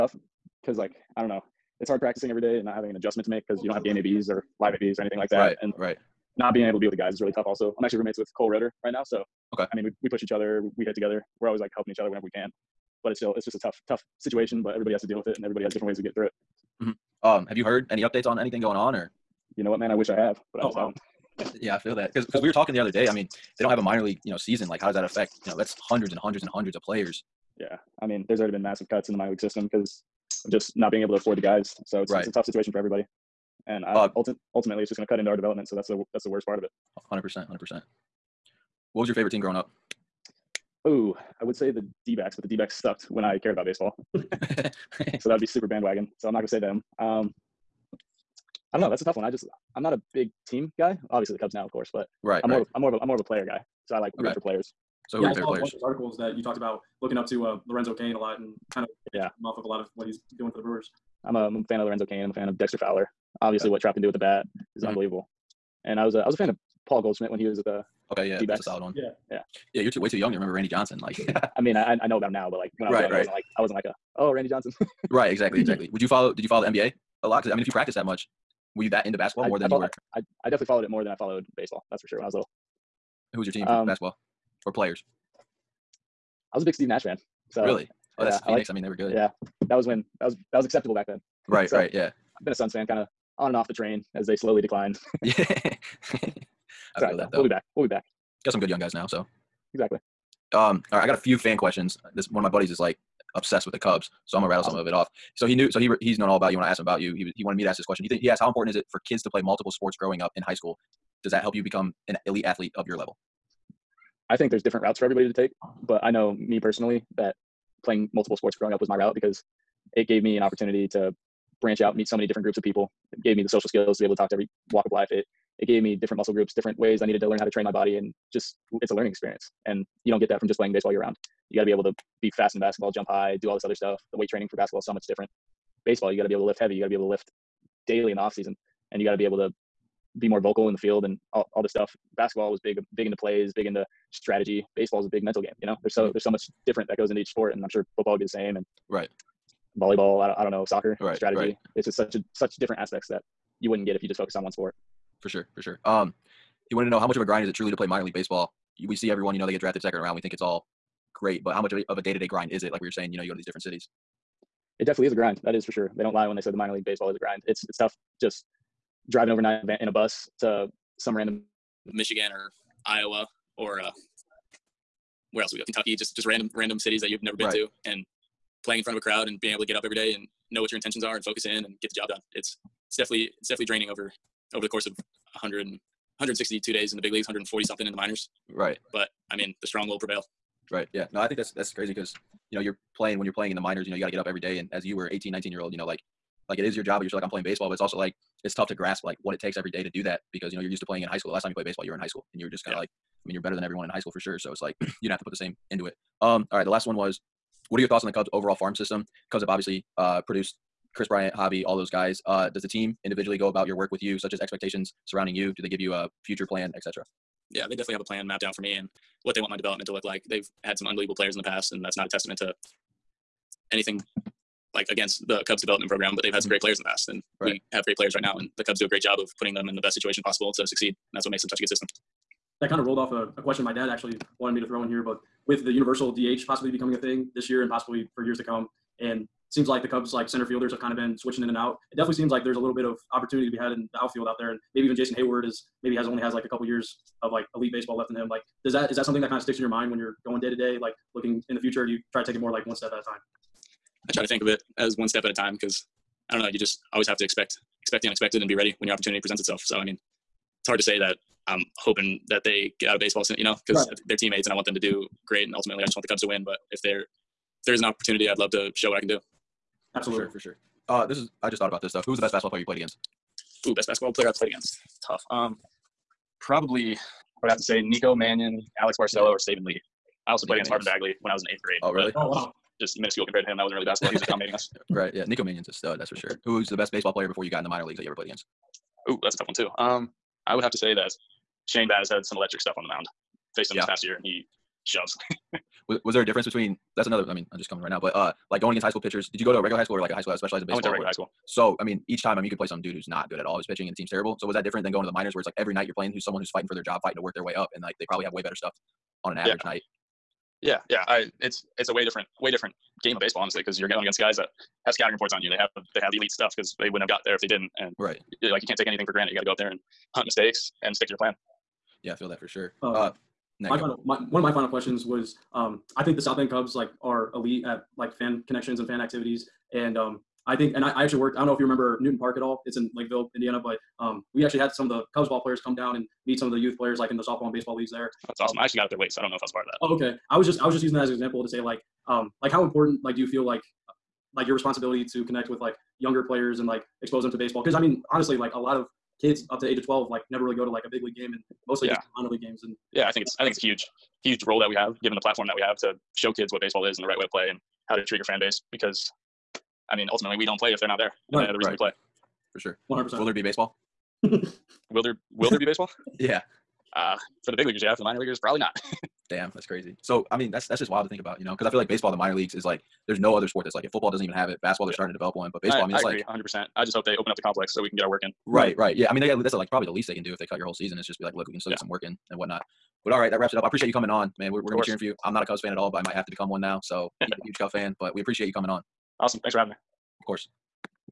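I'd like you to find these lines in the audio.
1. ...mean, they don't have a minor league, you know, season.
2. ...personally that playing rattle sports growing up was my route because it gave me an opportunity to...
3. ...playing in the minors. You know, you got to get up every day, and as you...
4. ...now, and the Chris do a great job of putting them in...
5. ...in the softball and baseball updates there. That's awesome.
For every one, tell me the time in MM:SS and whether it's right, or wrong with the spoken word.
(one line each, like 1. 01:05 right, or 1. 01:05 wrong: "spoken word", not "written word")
1. 00:23 right
2. 01:56 wrong: "multiple", not "rattle"
3. 03:13 right
4. 03:48 wrong: "Cubs", not "Chris"
5. 05:37 wrong: "leagues", not "updates".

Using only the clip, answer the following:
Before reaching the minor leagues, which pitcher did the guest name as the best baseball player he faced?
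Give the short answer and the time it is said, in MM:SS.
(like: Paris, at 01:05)
Shane Baz, at 04:51.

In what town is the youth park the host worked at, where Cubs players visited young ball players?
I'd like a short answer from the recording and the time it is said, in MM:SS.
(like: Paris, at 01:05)
Lakeville, Indiana, at 05:32.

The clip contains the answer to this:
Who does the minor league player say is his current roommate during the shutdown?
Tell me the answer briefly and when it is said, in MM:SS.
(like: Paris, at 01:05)
Cole Roederer, at 00:08.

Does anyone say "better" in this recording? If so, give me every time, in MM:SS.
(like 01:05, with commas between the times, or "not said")
03:23, 05:08.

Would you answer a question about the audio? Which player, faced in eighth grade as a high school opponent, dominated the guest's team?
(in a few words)
Marvin Bagley.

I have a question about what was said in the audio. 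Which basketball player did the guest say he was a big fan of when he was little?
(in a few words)
Steve Nash.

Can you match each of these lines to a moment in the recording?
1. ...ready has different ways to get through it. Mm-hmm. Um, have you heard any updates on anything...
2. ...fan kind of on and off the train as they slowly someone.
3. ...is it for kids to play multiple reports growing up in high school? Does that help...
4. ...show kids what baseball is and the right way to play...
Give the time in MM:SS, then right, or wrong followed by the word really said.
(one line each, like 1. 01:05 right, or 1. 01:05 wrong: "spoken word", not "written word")
1. 00:15 wrong: "everybody", not "ready"
2. 01:32 wrong: "decline", not "someone"
3. 01:48 wrong: "sports", not "reports"
4. 05:56 right.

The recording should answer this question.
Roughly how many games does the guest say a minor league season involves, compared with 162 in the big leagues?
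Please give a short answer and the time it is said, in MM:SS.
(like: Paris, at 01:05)
140 something, at 03:07.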